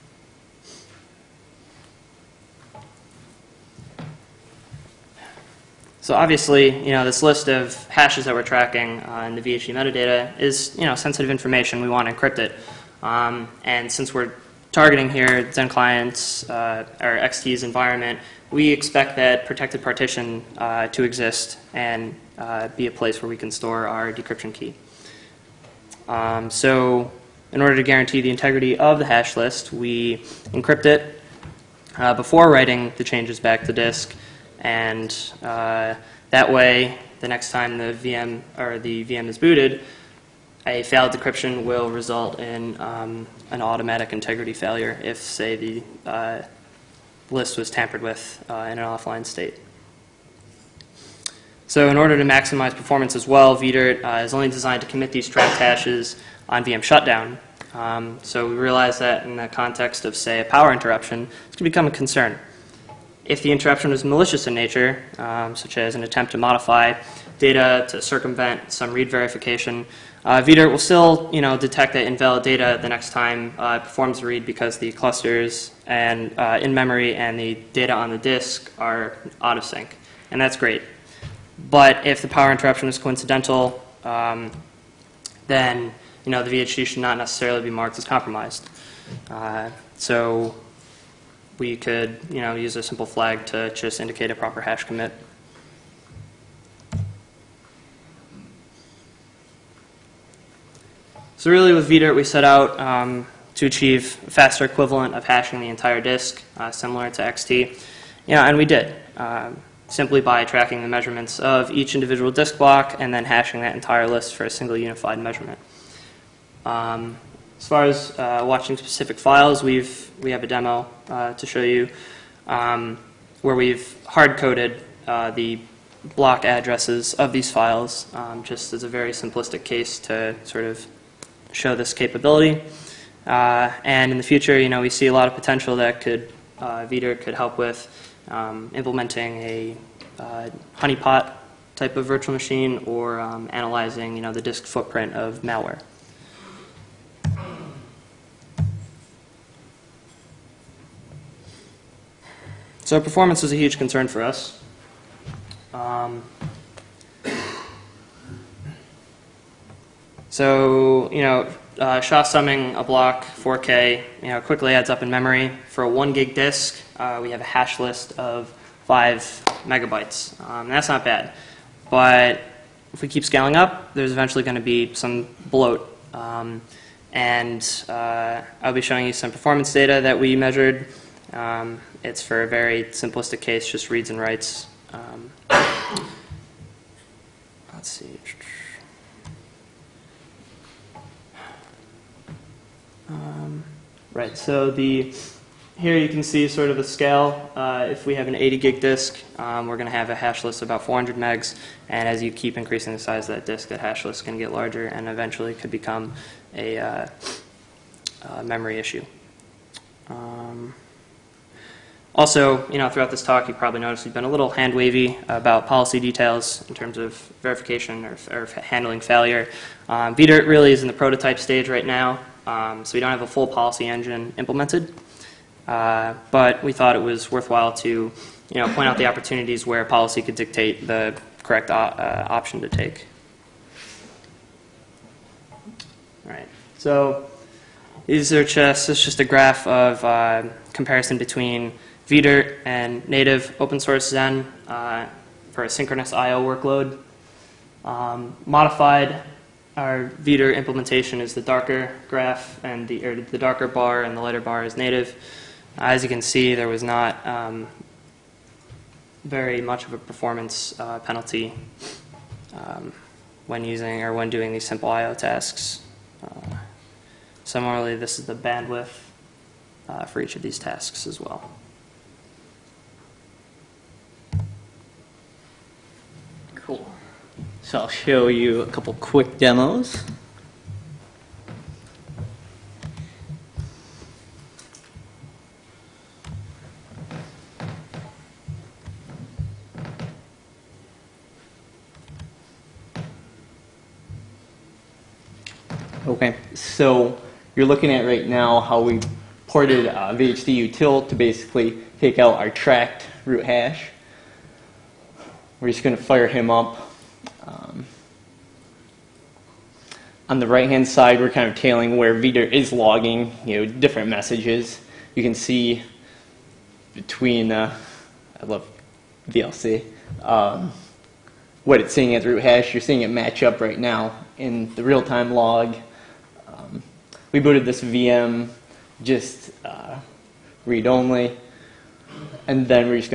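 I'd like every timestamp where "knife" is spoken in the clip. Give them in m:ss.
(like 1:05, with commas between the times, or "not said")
not said.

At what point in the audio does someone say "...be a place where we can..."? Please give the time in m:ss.
0:22.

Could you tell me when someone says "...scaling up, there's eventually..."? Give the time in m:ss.
2:53.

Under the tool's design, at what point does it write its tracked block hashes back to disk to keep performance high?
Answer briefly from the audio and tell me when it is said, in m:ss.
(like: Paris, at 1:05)
VM shutdown, at 0:56.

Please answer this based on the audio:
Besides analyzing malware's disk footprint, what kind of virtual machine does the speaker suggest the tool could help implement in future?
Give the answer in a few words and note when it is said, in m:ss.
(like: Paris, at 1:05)
honeypot, at 2:20.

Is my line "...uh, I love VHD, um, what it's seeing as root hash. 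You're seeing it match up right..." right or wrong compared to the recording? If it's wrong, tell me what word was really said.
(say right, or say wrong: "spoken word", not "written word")
wrong: "VLC", not "VHD".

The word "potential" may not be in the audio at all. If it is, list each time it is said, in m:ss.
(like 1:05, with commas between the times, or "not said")
2:15.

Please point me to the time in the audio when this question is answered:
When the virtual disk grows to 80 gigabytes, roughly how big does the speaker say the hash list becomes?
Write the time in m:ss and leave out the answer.
3:20.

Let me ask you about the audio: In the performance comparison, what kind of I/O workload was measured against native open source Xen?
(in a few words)
synchronous.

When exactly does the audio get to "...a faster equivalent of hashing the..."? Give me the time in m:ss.
1:44.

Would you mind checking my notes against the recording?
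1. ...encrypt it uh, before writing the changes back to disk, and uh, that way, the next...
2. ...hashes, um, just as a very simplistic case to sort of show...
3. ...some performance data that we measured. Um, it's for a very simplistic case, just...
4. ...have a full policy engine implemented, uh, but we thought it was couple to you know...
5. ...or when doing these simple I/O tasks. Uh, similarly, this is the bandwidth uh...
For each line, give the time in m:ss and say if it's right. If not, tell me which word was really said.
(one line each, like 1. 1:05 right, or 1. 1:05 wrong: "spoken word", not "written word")
1. 0:30 right
2. 2:07 wrong: "files", not "hashes"
3. 2:59 right
4. 3:43 wrong: "worthwhile", not "couple"
5. 4:24 right.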